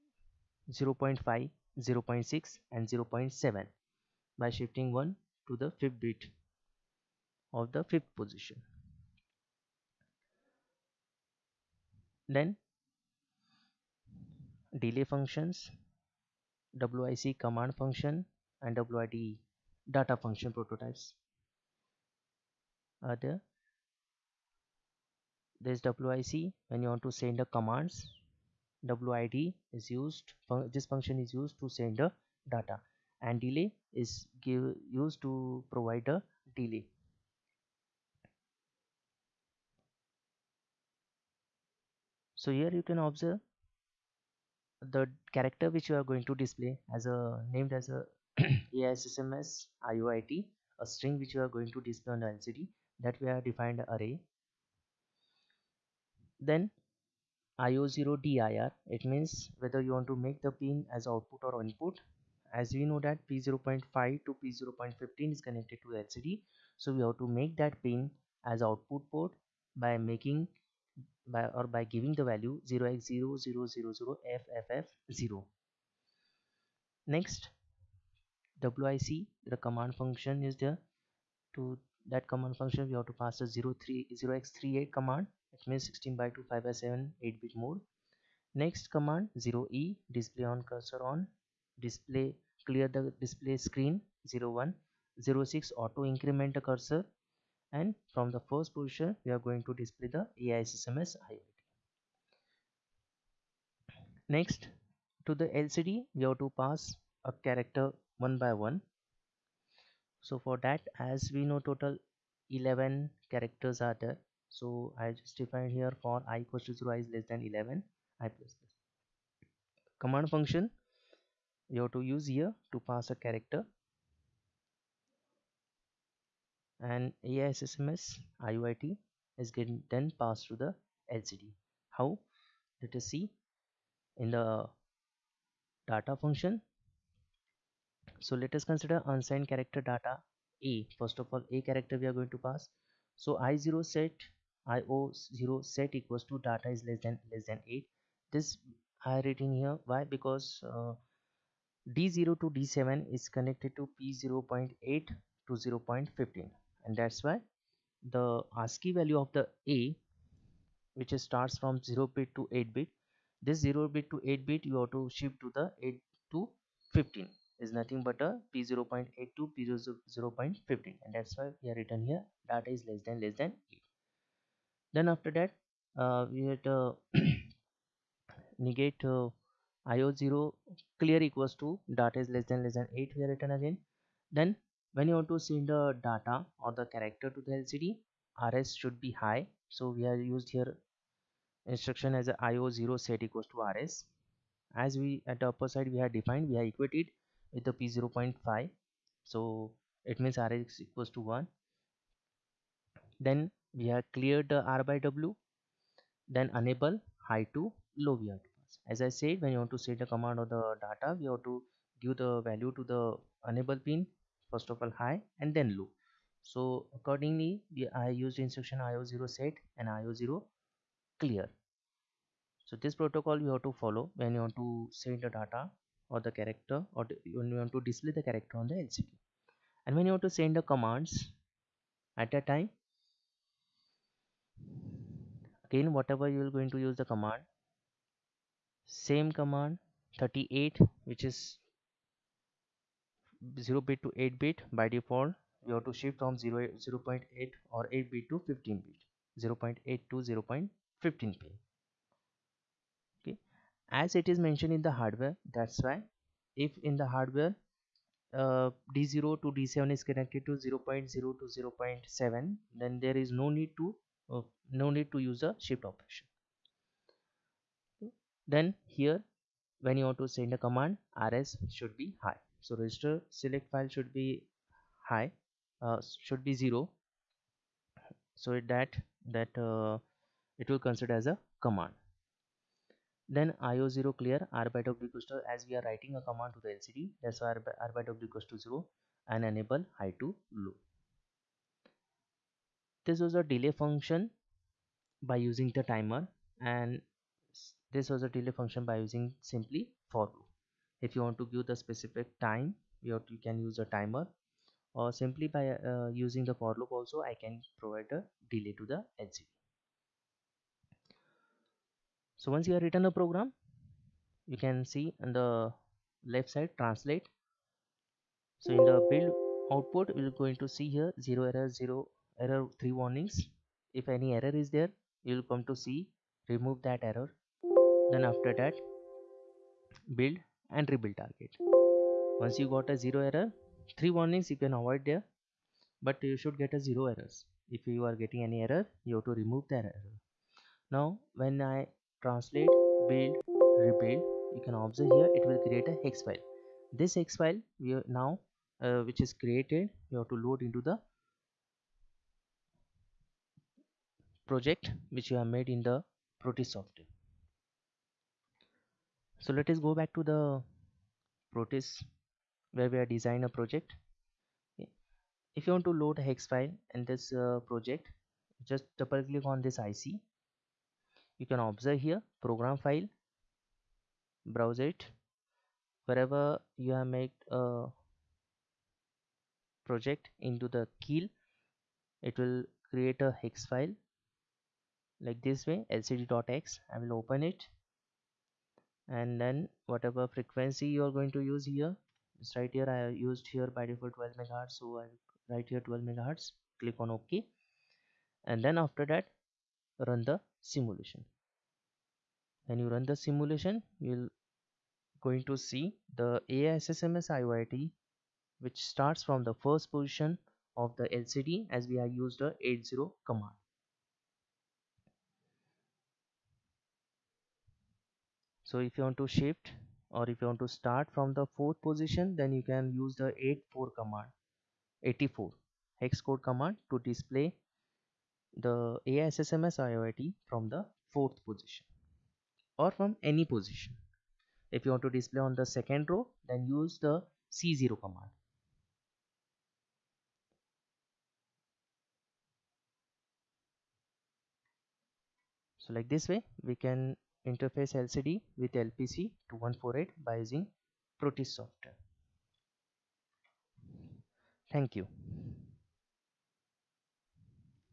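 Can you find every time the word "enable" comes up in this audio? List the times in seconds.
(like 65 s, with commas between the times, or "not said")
206 s, 213 s, 289 s.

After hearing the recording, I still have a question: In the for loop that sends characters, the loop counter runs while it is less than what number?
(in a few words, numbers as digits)
11.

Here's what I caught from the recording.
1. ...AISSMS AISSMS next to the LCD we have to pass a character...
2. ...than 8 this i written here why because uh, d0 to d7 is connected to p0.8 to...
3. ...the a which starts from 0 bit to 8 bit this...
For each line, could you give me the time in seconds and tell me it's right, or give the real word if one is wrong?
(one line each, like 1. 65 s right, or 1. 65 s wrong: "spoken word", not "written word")
1. 100 s wrong: "IOIT", not "AISSMS"
2. 147 s right
3. 159 s right.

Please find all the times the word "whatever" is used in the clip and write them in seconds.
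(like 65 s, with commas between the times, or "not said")
235 s, 389 s.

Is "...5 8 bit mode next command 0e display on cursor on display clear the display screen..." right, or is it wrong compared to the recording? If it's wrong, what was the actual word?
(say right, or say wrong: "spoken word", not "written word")
wrong: "7", not "5".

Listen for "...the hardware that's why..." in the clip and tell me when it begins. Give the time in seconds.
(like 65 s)
254 s.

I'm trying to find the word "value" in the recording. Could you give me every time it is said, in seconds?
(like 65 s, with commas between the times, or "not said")
72 s, 158 s, 212 s.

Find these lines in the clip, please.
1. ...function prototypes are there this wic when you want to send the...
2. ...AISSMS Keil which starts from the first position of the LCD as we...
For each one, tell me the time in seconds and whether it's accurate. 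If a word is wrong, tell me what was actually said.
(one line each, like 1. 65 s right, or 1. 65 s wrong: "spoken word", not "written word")
1. 20 s right
2. 406 s wrong: "IOIT", not "Keil".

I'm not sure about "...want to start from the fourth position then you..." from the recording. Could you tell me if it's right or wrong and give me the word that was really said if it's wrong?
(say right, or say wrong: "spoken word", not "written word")
right.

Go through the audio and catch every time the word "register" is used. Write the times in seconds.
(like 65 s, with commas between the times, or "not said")
272 s.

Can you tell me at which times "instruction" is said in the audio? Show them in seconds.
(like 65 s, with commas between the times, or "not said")
191 s, 218 s.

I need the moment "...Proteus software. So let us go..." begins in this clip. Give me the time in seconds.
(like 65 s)
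356 s.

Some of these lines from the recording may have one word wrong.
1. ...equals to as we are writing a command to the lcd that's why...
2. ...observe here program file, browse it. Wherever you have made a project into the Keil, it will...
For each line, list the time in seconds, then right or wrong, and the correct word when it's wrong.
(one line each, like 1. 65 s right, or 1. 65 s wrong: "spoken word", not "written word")
1. 285 s right
2. 371 s right.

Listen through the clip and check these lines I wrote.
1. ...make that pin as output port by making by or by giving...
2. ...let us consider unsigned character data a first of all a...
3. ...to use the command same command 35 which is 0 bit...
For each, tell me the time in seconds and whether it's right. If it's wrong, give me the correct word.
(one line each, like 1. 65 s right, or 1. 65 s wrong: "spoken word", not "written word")
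1. 67 s right
2. 138 s right
3. 236 s wrong: "38", not "35".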